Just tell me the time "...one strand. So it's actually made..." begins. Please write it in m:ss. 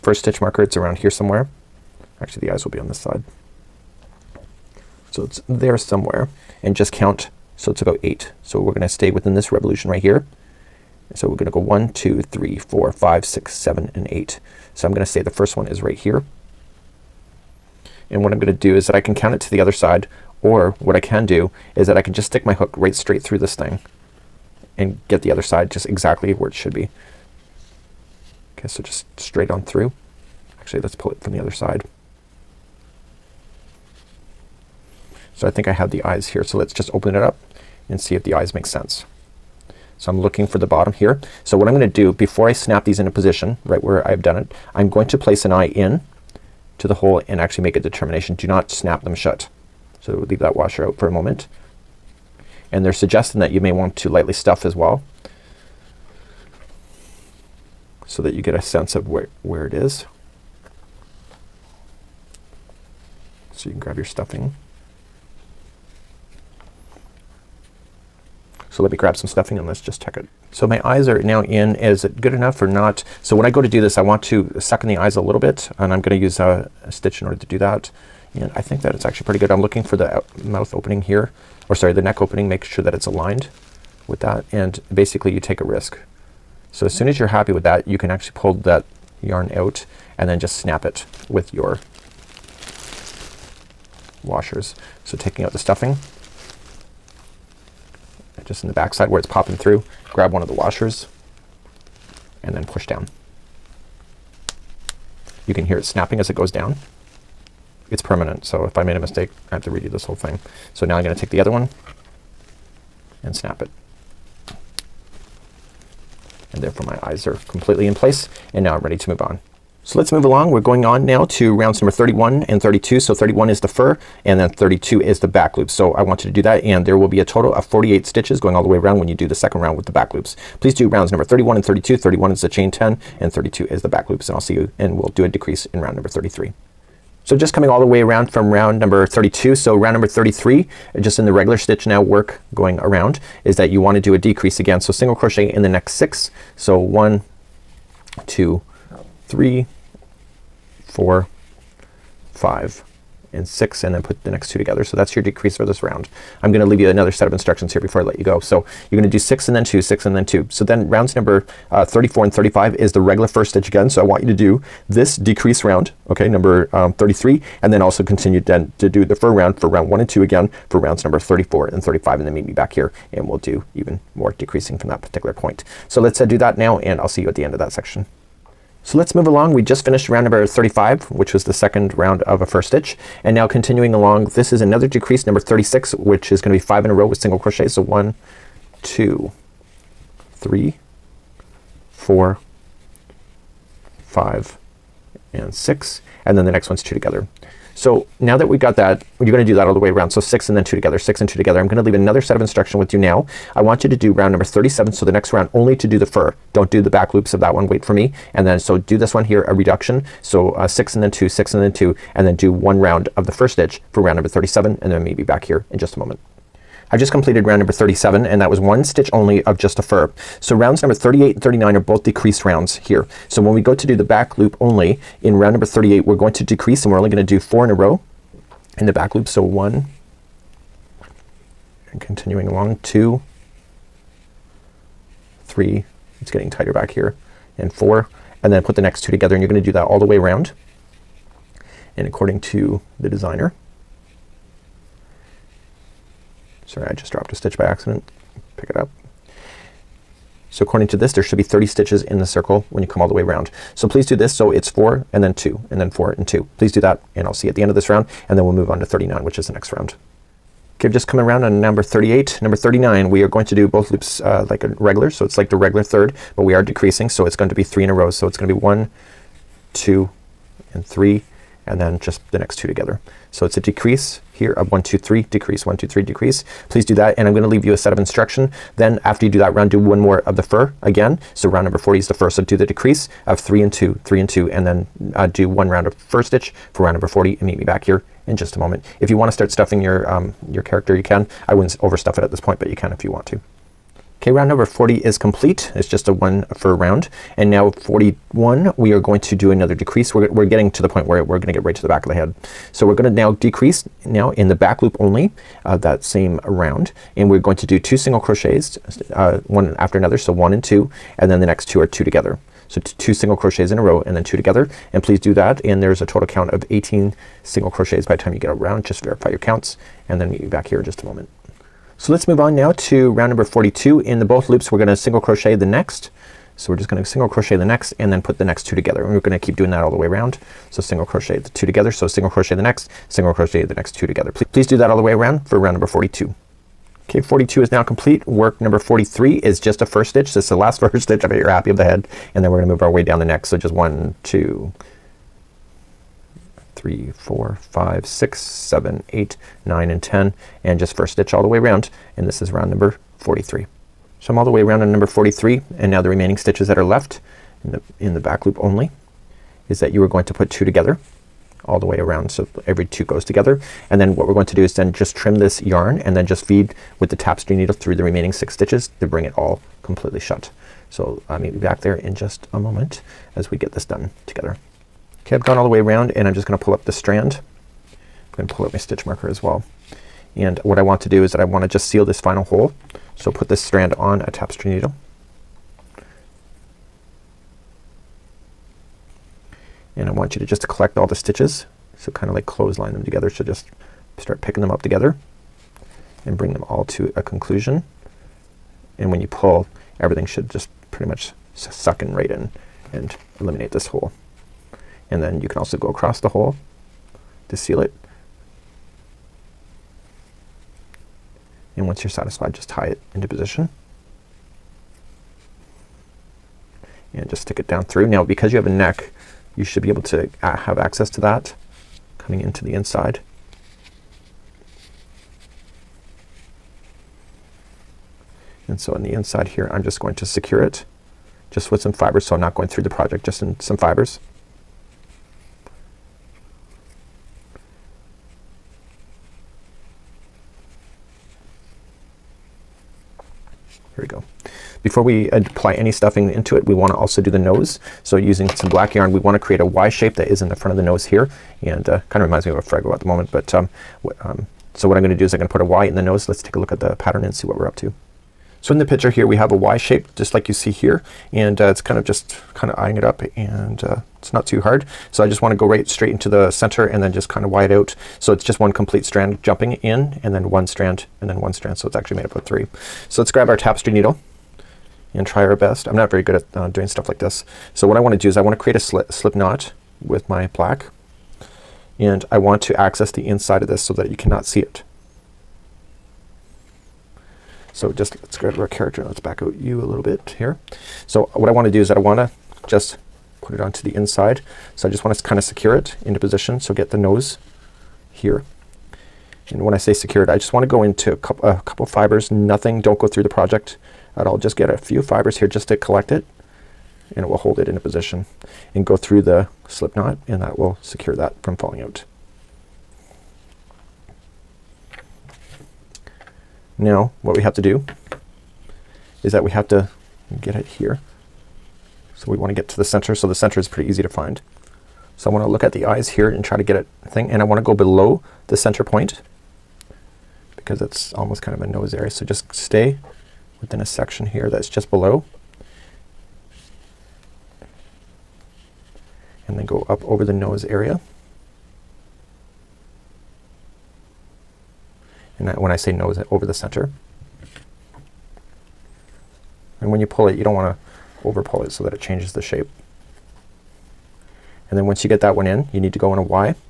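7:51.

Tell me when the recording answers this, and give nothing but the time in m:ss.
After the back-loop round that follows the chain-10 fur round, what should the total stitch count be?
2:07.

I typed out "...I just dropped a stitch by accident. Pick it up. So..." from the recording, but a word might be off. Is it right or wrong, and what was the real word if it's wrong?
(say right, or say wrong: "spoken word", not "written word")
right.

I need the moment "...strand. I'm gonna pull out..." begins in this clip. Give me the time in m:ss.
6:16.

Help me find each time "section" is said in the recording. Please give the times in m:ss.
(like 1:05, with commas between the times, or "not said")
2:57, 8:53.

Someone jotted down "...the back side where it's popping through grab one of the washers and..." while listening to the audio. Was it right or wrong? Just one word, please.
right.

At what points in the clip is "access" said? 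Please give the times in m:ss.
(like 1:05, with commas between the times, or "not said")
7:00, 8:02.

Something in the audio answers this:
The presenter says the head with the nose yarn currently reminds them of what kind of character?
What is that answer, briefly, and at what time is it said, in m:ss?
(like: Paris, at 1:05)
Fraggle, at 7:32.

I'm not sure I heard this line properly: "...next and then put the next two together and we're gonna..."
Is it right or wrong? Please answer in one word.
right.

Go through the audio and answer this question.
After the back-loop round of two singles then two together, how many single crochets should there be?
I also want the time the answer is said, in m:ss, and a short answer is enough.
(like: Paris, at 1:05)
18, at 5:16.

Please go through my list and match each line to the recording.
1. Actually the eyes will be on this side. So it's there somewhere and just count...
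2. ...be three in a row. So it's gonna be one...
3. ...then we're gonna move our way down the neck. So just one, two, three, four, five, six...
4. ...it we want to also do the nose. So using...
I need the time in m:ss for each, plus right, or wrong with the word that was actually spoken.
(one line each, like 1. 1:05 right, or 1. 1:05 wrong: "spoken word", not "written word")
1. 0:02 right
2. 4:27 right
3. 5:42 right
4. 7:26 right.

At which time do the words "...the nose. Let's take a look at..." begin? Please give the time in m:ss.
7:35.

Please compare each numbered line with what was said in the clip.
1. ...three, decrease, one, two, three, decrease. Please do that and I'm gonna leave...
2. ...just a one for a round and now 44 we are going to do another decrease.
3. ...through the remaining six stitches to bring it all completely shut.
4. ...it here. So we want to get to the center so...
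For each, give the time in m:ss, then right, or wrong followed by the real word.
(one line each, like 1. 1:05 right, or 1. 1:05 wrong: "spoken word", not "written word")
1. 4:34 right
2. 4:55 wrong: "41", not "44"
3. 6:07 right
4. 8:40 right.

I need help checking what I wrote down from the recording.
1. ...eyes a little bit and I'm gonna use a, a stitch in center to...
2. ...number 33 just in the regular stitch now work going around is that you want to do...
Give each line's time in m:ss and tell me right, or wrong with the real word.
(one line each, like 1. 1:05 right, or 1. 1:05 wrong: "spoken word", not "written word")
1. 1:14 wrong: "order", not "center"
2. 2:19 right.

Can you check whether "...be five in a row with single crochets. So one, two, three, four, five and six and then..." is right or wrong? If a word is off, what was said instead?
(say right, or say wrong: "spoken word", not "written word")
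right.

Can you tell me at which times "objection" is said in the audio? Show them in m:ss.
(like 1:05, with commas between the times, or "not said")
not said.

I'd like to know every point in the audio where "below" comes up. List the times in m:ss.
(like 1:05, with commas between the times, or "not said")
8:47, 8:54.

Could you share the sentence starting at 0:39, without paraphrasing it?
So I'm looking for the bottom here.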